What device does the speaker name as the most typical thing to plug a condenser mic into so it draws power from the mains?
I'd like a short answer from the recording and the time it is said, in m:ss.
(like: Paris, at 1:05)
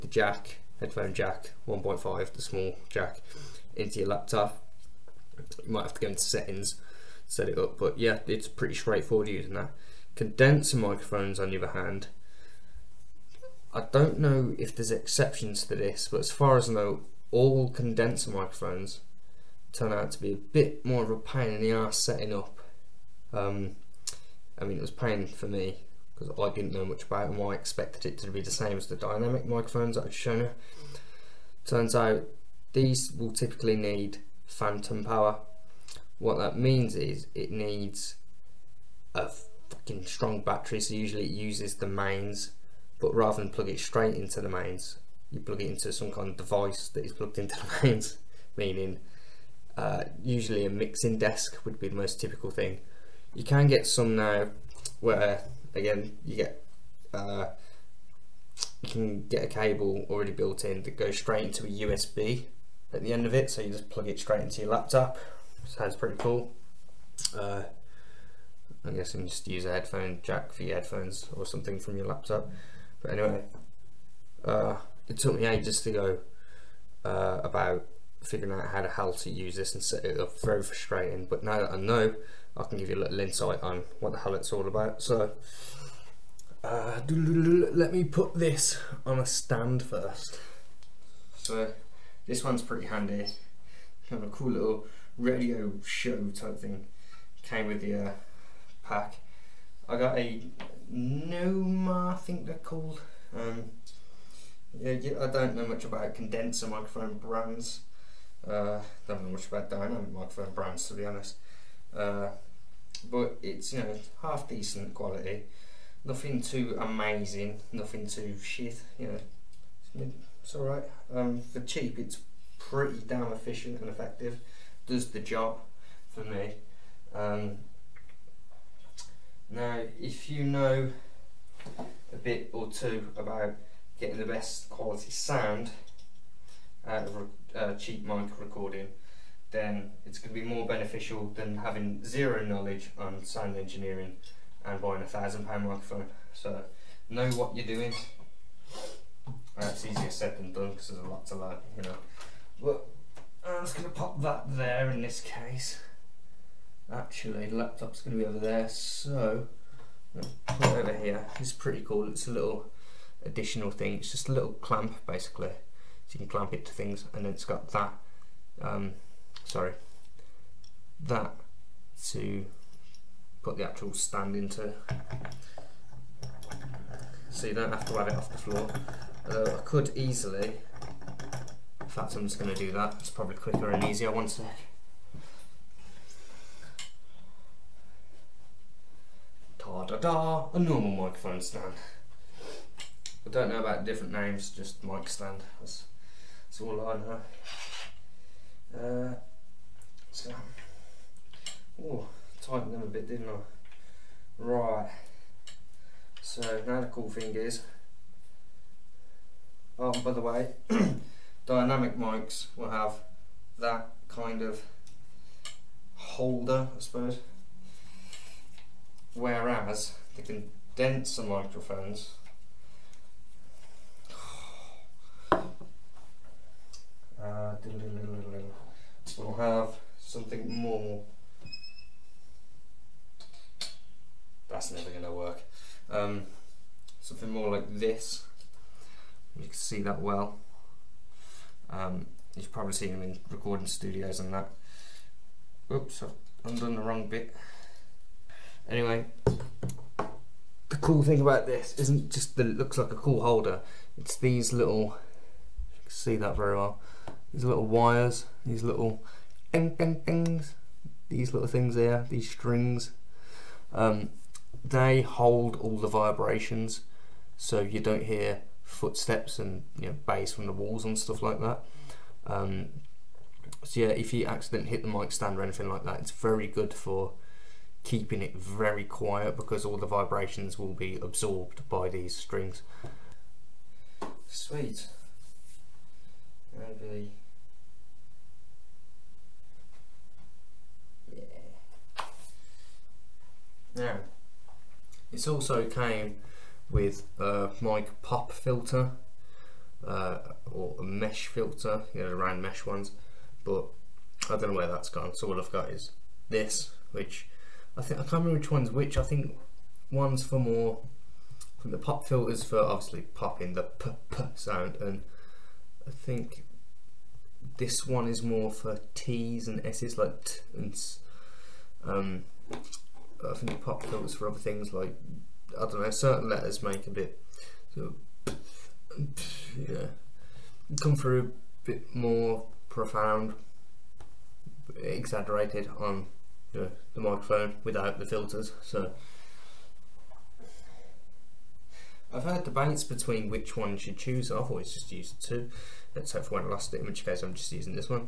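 mixing desk, at 0:50.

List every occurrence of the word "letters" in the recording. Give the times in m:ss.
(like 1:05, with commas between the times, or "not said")
5:26.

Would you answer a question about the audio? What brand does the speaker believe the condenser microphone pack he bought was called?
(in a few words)
Noma.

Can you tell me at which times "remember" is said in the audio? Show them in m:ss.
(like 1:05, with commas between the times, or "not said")
5:08.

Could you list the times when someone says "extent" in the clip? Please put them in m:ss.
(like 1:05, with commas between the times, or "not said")
not said.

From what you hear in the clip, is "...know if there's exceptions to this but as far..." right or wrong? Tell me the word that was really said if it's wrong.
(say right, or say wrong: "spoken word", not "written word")
right.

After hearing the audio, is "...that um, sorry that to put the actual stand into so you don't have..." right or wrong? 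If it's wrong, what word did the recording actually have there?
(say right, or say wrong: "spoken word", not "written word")
right.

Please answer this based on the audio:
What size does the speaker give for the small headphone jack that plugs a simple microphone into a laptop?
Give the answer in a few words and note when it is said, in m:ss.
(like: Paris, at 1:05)
1.5, at 0:01.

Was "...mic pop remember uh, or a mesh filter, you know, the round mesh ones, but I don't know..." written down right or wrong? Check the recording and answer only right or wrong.
wrong.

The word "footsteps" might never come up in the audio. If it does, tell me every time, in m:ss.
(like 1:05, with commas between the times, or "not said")
4:28.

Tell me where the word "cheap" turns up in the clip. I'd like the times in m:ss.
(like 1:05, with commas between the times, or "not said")
2:01, 2:17.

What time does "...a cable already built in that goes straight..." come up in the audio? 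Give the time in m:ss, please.
0:59.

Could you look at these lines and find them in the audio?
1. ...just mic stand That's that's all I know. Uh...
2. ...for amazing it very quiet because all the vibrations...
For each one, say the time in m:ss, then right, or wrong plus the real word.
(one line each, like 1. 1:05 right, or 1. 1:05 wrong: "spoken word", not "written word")
1. 3:14 right
2. 4:36 wrong: "keeping", not "amazing".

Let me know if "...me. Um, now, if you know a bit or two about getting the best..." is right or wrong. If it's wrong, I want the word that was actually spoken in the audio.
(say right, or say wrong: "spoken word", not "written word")
right.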